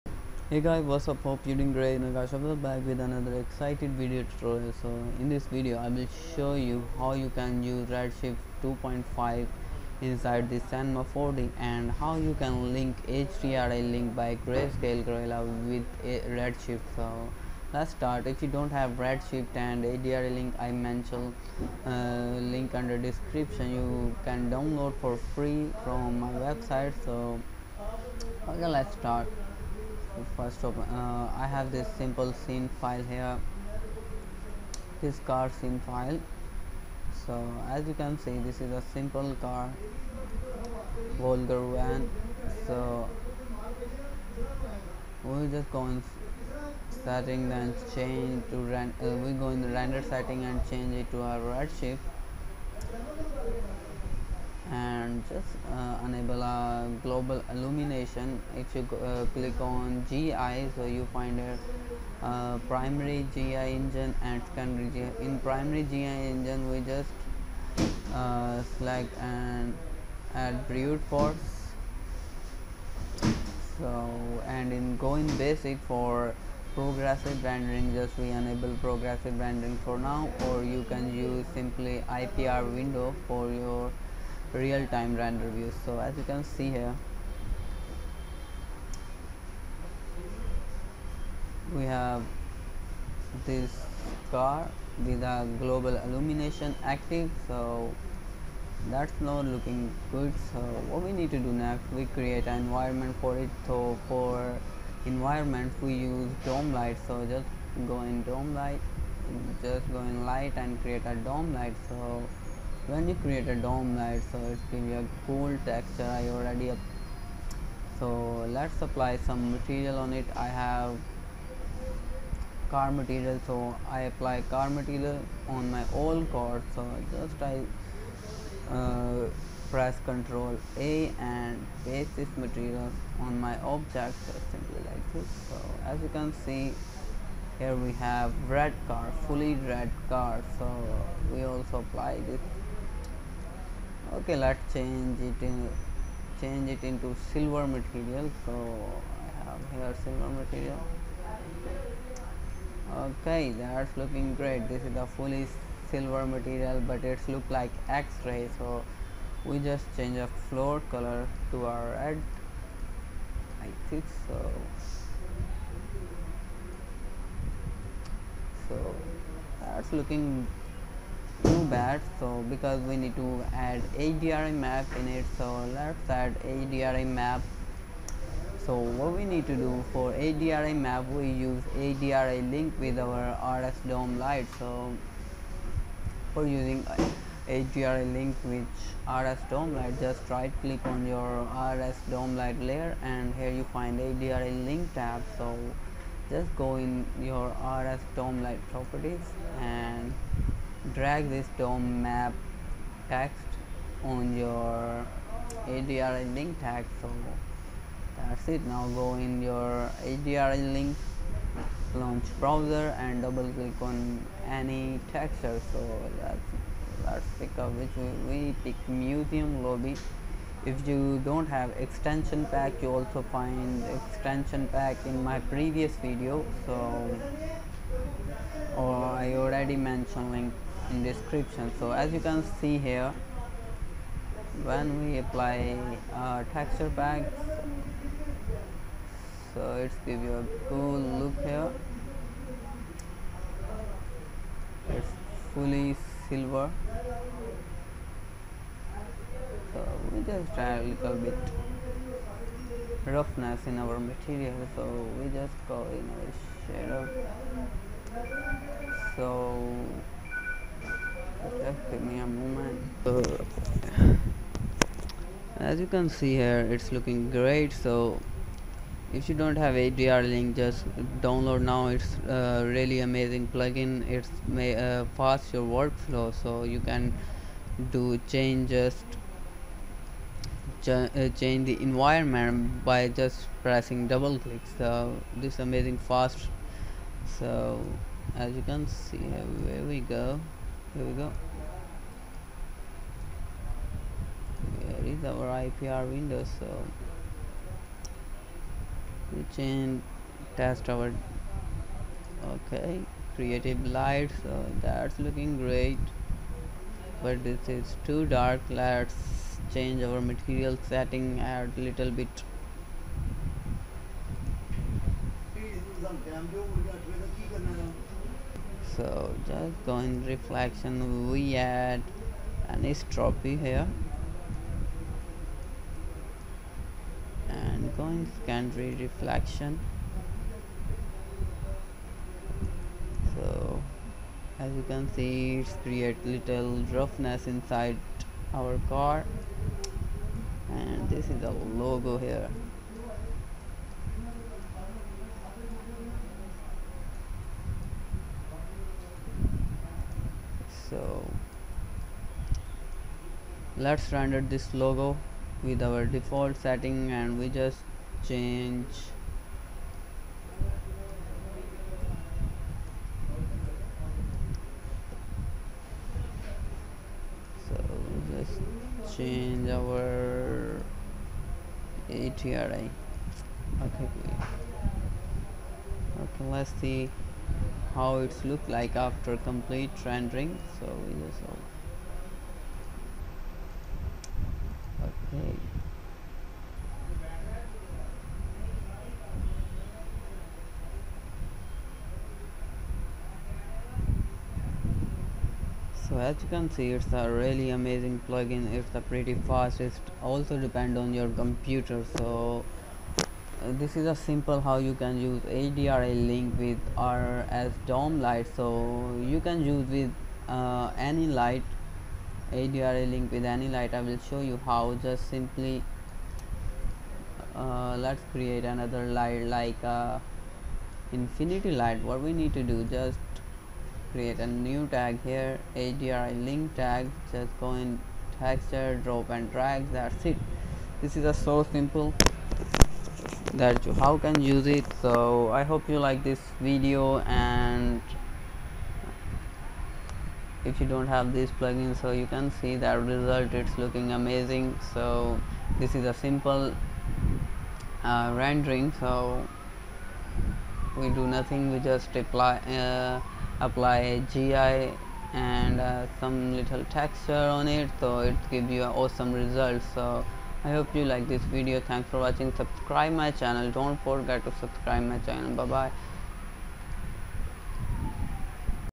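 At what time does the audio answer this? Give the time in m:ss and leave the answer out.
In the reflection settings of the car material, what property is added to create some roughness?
5:22.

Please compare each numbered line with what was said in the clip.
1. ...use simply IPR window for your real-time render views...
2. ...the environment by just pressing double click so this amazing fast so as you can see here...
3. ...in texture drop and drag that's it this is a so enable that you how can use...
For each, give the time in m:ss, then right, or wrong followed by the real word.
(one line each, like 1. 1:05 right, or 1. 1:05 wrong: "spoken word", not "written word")
1. 1:21 right
2. 4:41 right
3. 7:07 wrong: "simple", not "enable".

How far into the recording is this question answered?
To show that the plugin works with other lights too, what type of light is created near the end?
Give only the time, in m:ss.
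7:01.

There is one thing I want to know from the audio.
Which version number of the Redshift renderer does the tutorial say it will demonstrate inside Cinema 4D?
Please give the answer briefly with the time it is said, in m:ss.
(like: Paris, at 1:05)
2.5, at 0:08.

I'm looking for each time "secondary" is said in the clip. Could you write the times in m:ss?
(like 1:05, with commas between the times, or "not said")
1:04, 5:28.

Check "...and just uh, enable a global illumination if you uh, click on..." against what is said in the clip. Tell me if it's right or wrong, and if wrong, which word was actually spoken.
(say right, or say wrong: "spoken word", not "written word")
right.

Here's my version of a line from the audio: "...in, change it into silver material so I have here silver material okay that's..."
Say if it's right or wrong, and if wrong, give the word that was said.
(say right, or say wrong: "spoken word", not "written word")
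right.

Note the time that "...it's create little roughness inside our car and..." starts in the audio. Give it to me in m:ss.
5:35.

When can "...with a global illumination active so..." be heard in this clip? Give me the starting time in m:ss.
1:35.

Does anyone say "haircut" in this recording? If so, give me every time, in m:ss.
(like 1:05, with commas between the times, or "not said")
not said.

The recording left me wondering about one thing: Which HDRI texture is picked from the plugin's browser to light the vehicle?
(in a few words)
Museum lobby.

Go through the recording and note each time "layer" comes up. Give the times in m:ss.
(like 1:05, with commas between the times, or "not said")
3:12.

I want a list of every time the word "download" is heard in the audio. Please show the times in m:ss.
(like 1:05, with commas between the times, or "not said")
0:24, 4:31.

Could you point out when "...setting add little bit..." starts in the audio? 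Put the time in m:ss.
5:10.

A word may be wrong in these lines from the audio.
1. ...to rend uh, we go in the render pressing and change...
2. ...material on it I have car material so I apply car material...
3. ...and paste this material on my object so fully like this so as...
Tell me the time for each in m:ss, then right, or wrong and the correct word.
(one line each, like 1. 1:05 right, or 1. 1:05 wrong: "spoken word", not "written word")
1. 0:48 wrong: "setting", not "pressing"
2. 1:59 right
3. 2:11 wrong: "simply", not "fully".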